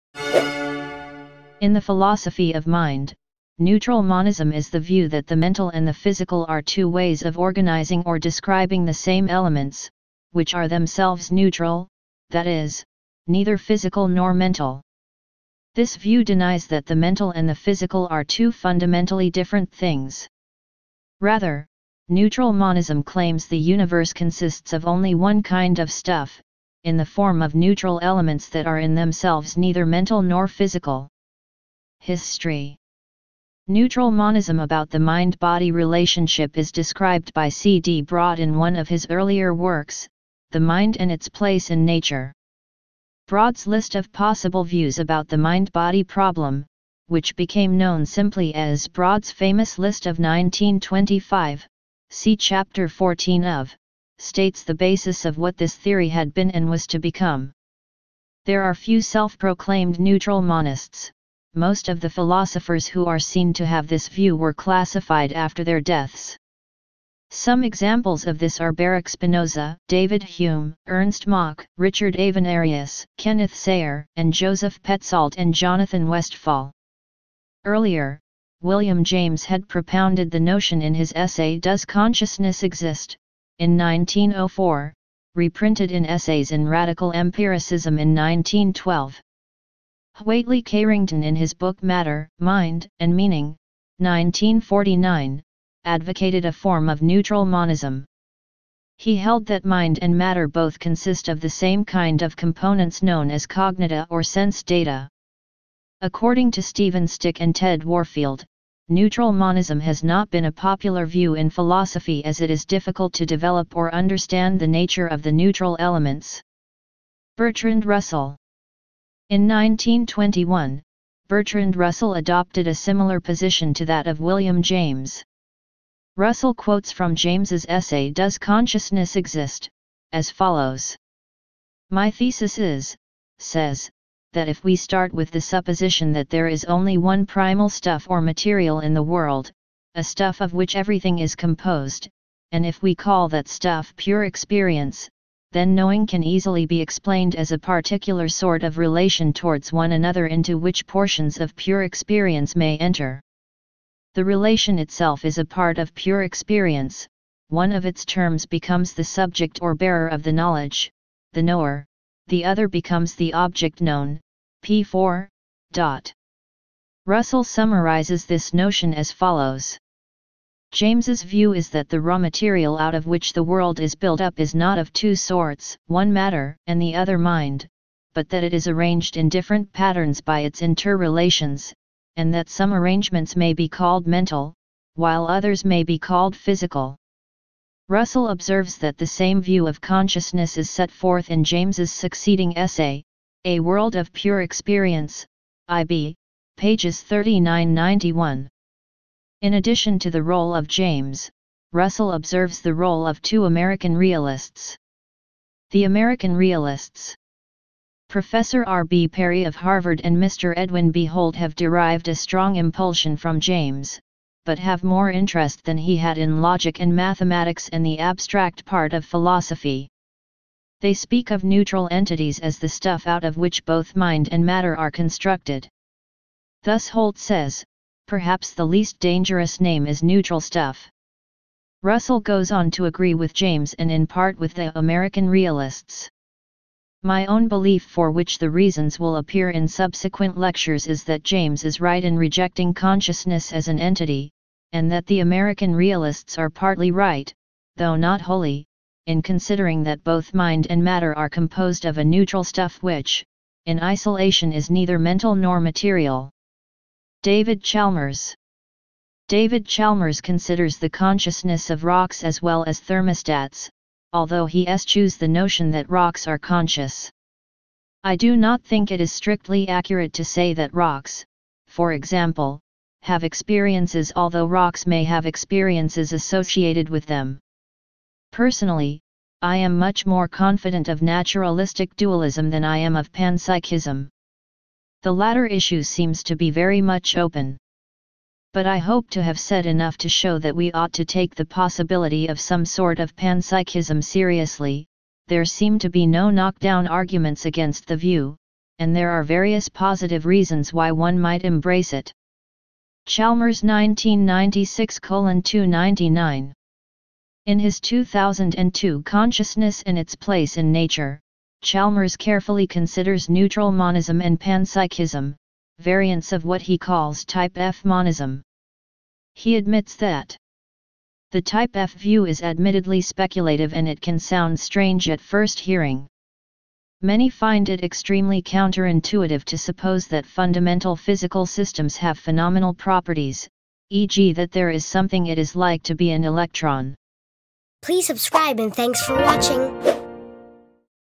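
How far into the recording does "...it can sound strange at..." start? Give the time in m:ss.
5:23.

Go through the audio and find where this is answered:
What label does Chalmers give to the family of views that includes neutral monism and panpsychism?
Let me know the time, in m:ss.
5:17.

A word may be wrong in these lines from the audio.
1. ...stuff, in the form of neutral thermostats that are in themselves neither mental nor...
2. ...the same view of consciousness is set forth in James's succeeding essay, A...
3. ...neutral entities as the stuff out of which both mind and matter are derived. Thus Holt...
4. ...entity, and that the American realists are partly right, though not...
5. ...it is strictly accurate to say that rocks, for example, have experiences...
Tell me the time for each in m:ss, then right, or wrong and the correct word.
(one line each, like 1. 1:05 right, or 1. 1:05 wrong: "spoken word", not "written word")
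1. 0:25 wrong: "elements", not "thermostats"
2. 3:08 right
3. 3:41 wrong: "constructed", not "derived"
4. 4:03 right
5. 4:28 right.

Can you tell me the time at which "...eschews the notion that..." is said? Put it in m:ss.
4:24.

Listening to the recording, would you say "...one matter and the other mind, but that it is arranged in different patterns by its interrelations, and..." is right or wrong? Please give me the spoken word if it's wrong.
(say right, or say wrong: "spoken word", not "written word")
right.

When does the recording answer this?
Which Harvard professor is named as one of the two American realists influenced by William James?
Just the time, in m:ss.
3:28.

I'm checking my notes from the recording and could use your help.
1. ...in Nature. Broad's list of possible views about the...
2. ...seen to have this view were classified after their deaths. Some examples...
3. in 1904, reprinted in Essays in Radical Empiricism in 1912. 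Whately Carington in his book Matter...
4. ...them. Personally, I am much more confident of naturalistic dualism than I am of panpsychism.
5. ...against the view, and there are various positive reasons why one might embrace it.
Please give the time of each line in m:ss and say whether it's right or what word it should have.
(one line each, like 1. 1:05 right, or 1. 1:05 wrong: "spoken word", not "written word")
1. 0:41 right
2. 1:03 right
3. 1:23 right
4. 4:37 right
5. 4:57 right.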